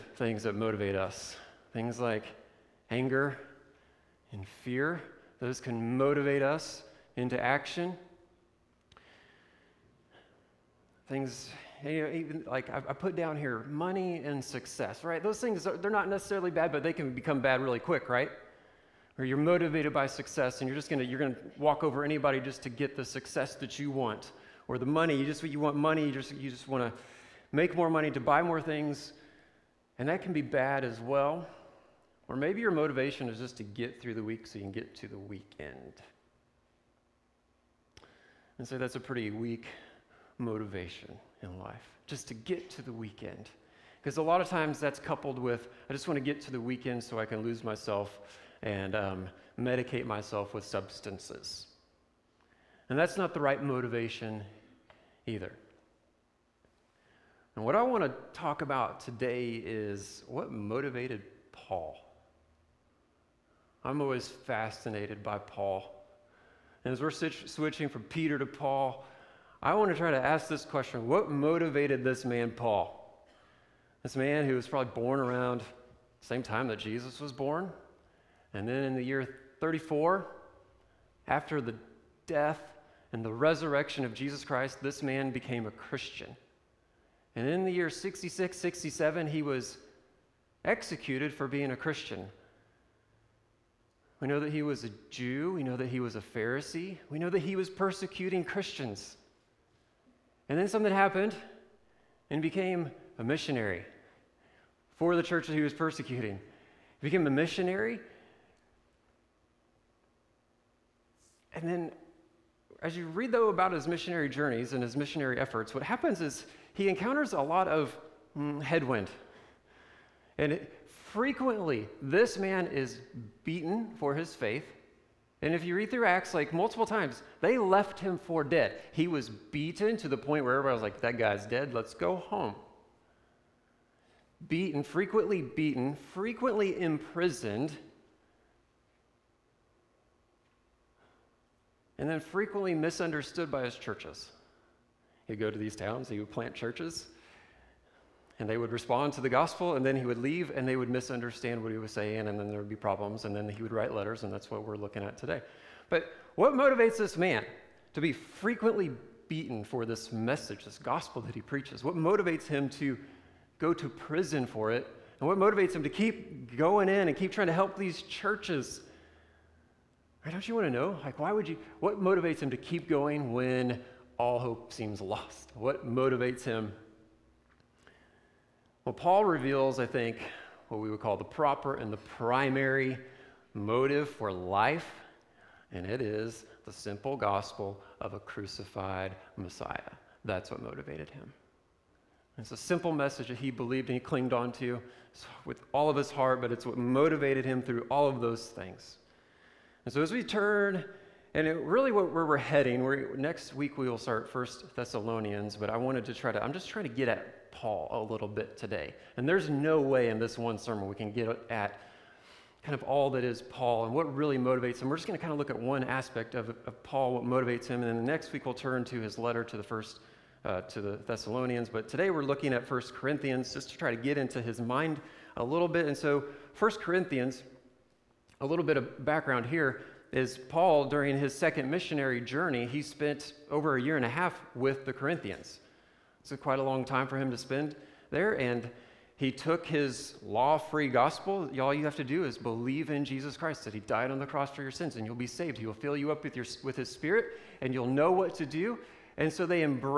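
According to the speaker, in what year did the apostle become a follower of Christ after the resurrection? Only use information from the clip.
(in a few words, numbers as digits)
34.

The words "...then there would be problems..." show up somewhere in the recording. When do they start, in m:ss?
2:32.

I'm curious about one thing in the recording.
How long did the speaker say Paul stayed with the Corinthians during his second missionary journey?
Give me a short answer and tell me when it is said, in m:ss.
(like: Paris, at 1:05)
a year and a half, at 3:53.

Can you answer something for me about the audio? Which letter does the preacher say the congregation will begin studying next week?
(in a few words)
First Thessalonians.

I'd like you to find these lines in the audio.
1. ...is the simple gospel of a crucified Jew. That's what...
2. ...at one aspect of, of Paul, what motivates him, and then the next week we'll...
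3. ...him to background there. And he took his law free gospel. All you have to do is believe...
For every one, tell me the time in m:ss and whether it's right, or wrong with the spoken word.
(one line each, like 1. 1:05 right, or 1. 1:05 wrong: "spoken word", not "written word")
1. 3:06 wrong: "Messiah", not "Jew"
2. 3:35 right
3. 3:57 wrong: "spend", not "background".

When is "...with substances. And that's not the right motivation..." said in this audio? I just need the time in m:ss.
0:50.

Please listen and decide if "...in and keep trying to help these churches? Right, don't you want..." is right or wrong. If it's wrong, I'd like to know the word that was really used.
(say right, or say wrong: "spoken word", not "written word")
right.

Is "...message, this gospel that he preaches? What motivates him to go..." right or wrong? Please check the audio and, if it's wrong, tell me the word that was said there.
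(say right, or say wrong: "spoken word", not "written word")
right.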